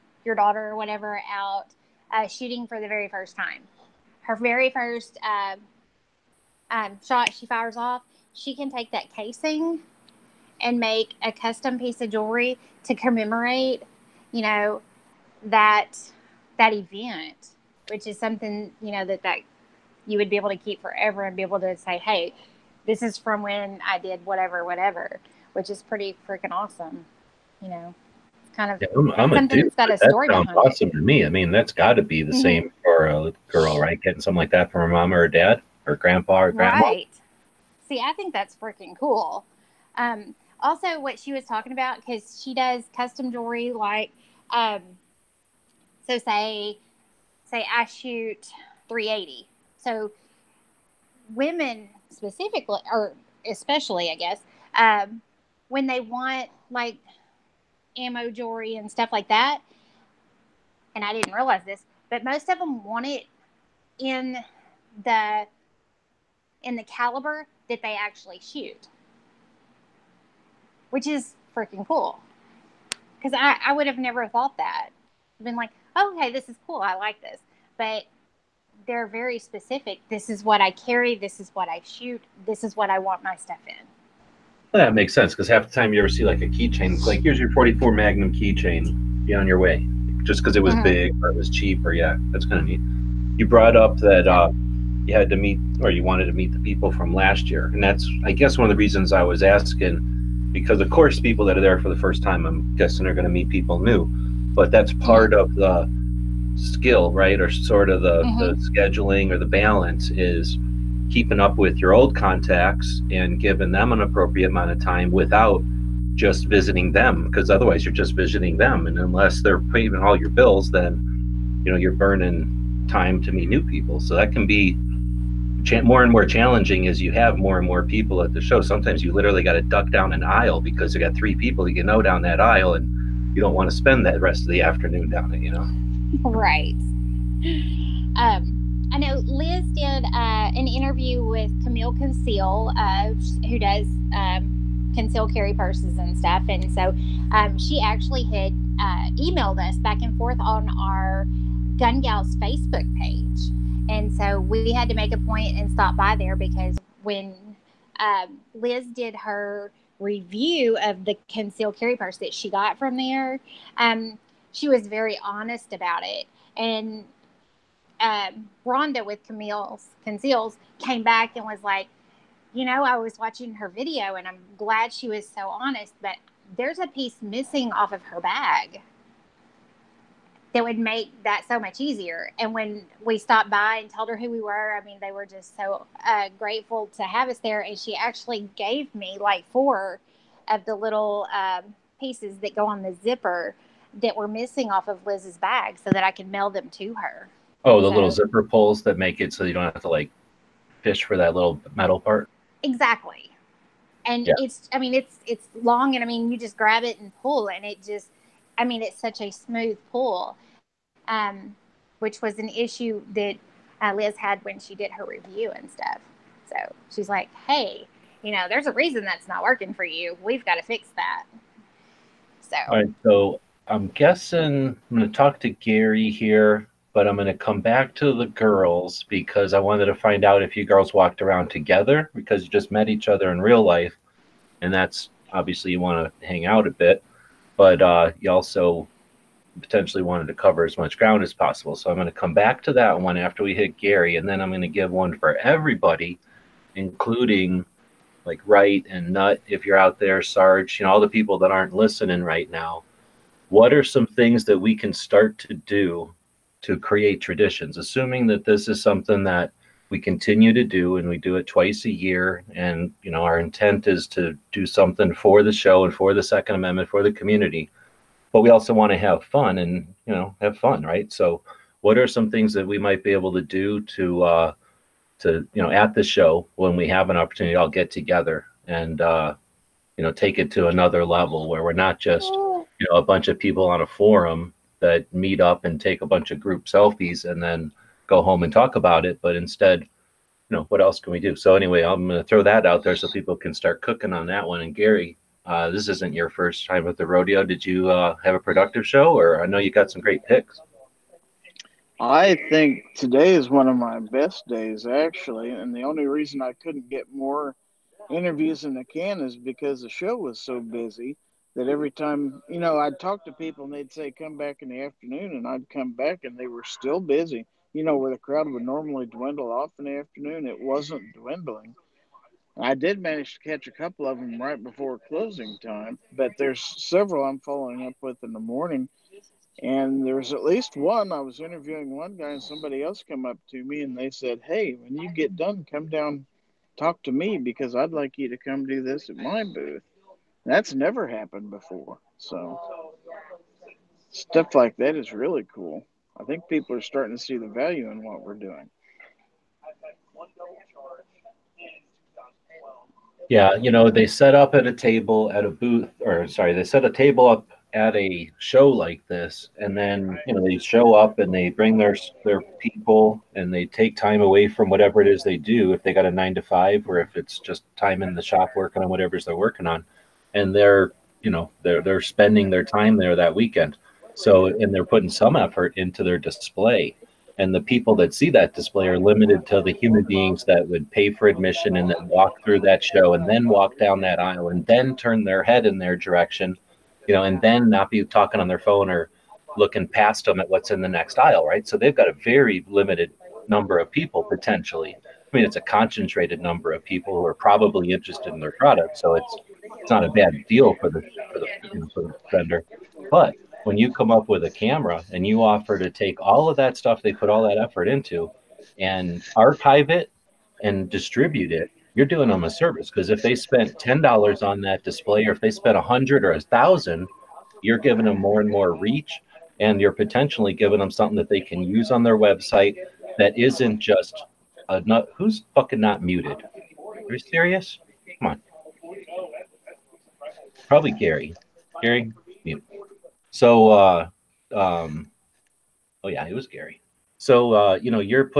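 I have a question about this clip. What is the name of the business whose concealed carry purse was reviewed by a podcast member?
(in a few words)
Camille's Conceals.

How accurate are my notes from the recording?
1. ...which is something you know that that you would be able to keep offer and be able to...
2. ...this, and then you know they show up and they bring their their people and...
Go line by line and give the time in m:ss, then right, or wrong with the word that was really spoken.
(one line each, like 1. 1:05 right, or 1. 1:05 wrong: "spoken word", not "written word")
1. 0:17 wrong: "forever", not "offer"
2. 5:59 right.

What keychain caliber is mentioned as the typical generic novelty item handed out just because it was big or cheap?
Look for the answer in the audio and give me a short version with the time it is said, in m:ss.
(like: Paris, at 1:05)
44 Magnum, at 1:27.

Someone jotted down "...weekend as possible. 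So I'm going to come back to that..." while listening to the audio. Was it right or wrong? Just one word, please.
wrong.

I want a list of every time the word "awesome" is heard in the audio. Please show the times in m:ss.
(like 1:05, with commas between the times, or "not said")
0:26, 0:30.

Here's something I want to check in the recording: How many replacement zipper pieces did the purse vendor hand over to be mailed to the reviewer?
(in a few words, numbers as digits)
4.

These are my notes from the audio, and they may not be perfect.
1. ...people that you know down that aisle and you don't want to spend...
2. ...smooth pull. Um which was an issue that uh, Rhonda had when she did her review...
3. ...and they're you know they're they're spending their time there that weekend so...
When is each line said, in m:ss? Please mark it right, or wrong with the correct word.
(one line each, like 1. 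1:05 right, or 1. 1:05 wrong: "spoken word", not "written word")
1. 2:11 right
2. 3:29 wrong: "Liz", not "Rhonda"
3. 6:10 right.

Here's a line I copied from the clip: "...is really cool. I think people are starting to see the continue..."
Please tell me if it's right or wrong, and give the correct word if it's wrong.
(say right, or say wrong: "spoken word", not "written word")
wrong: "value", not "continue".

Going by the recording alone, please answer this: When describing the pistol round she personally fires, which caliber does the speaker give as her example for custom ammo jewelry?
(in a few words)
380.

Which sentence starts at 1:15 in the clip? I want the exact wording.
I've been like, okay, oh, this is cool.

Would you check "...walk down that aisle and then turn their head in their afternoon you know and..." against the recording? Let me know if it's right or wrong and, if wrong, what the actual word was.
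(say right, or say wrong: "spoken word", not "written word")
wrong: "direction", not "afternoon".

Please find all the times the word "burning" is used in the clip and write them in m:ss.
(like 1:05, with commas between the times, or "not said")
2:01.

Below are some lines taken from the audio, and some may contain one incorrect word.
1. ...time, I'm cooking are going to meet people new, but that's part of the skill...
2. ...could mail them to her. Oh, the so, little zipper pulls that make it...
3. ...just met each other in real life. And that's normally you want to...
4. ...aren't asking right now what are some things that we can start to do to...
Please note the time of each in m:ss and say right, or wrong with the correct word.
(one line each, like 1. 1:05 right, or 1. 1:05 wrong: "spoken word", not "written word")
1. 1:42 wrong: "guessing", not "cooking"
2. 3:16 right
3. 3:52 wrong: "obviously", not "normally"
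4. 4:11 wrong: "listening", not "asking".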